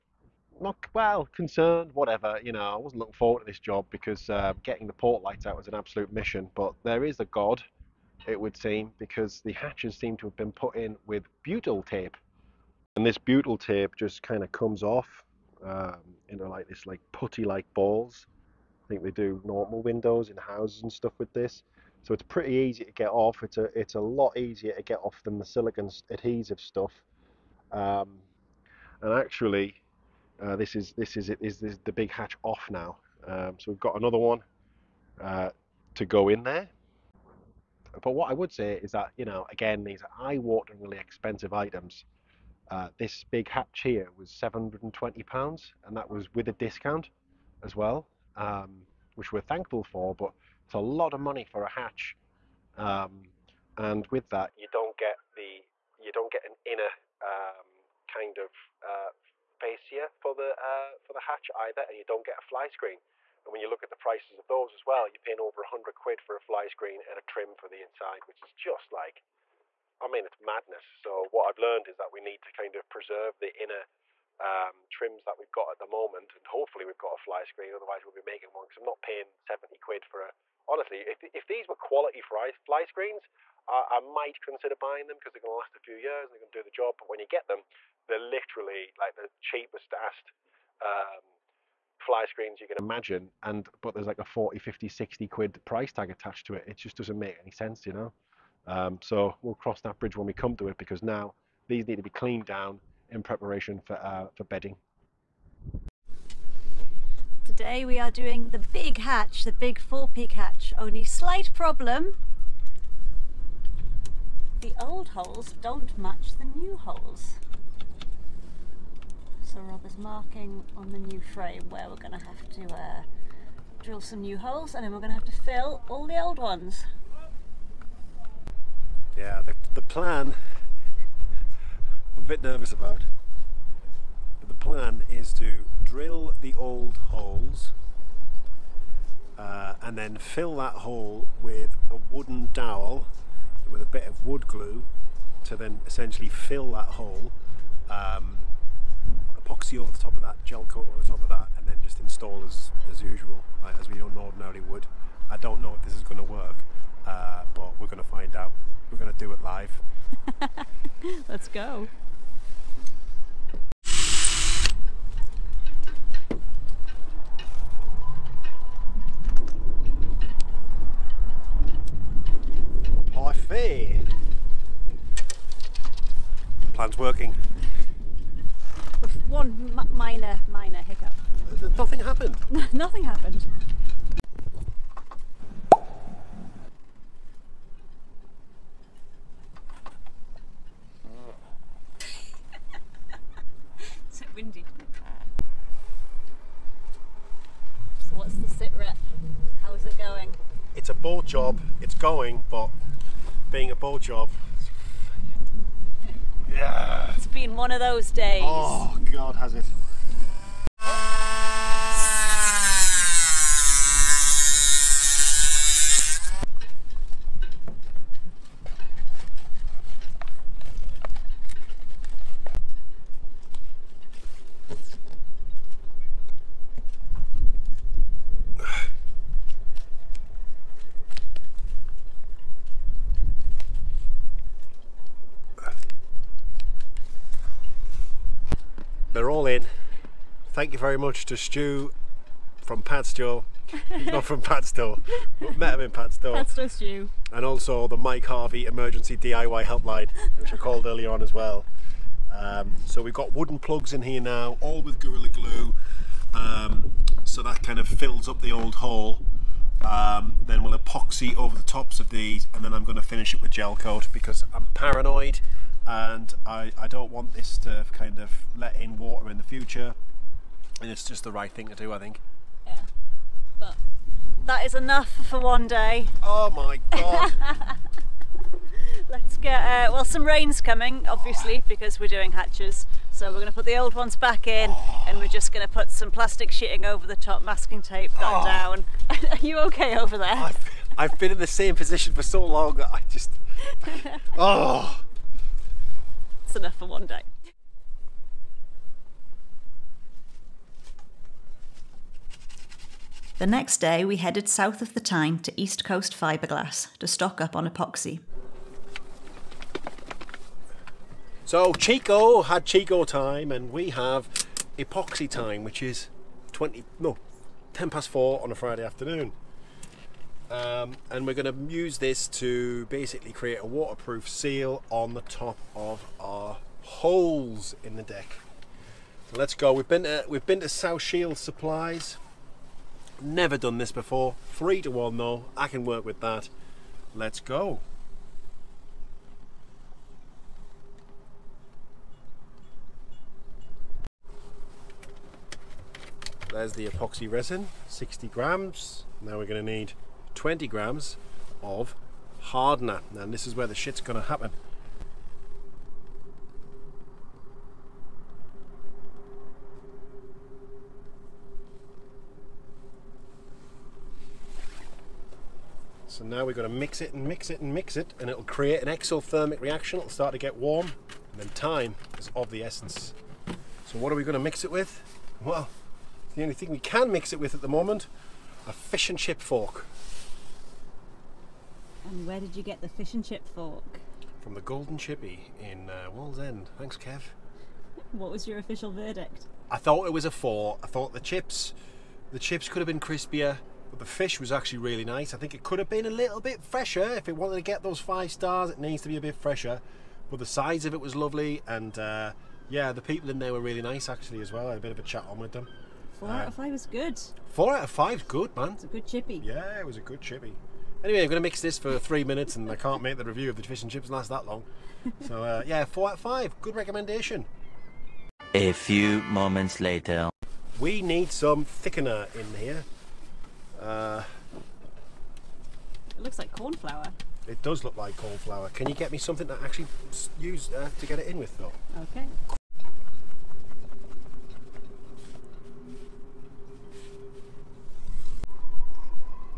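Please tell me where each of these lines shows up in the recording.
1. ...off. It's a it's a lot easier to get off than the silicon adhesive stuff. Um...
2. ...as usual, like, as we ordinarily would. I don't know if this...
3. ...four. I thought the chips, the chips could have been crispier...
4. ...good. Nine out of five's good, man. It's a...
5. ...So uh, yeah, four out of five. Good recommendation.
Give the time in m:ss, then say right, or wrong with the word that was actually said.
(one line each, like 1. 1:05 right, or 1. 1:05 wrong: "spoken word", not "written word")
1. 0:23 right
2. 2:32 right
3. 6:30 right
4. 6:46 wrong: "Four", not "Nine"
5. 6:55 right.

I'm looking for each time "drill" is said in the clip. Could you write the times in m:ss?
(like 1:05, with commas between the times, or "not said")
2:03, 2:15.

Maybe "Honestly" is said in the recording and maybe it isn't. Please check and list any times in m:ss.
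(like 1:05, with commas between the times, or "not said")
1:20.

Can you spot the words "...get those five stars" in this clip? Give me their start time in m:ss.
6:37.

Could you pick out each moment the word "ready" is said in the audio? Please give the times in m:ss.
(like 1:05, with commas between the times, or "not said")
not said.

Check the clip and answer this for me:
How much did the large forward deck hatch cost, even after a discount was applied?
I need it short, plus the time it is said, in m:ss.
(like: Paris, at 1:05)
720 pounds, at 0:44.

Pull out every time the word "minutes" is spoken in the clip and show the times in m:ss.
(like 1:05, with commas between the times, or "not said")
6:52.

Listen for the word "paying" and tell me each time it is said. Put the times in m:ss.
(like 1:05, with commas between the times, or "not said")
1:05, 1:19.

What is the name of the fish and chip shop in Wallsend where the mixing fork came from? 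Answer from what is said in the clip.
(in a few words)
Golden Chippy.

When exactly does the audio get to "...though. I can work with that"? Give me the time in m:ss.
5:35.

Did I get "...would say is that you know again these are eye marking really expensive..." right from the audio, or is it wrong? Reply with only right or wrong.
wrong.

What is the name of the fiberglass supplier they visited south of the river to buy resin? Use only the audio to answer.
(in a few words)
East Coast Fiberglass.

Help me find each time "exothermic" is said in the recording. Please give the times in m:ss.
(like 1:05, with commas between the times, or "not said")
6:08.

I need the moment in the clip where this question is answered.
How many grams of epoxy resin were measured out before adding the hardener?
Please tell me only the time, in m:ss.
5:47.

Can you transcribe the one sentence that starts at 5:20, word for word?
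Um, and we're going to use this to basically create a waterproof seal on the top of our holes in the deck.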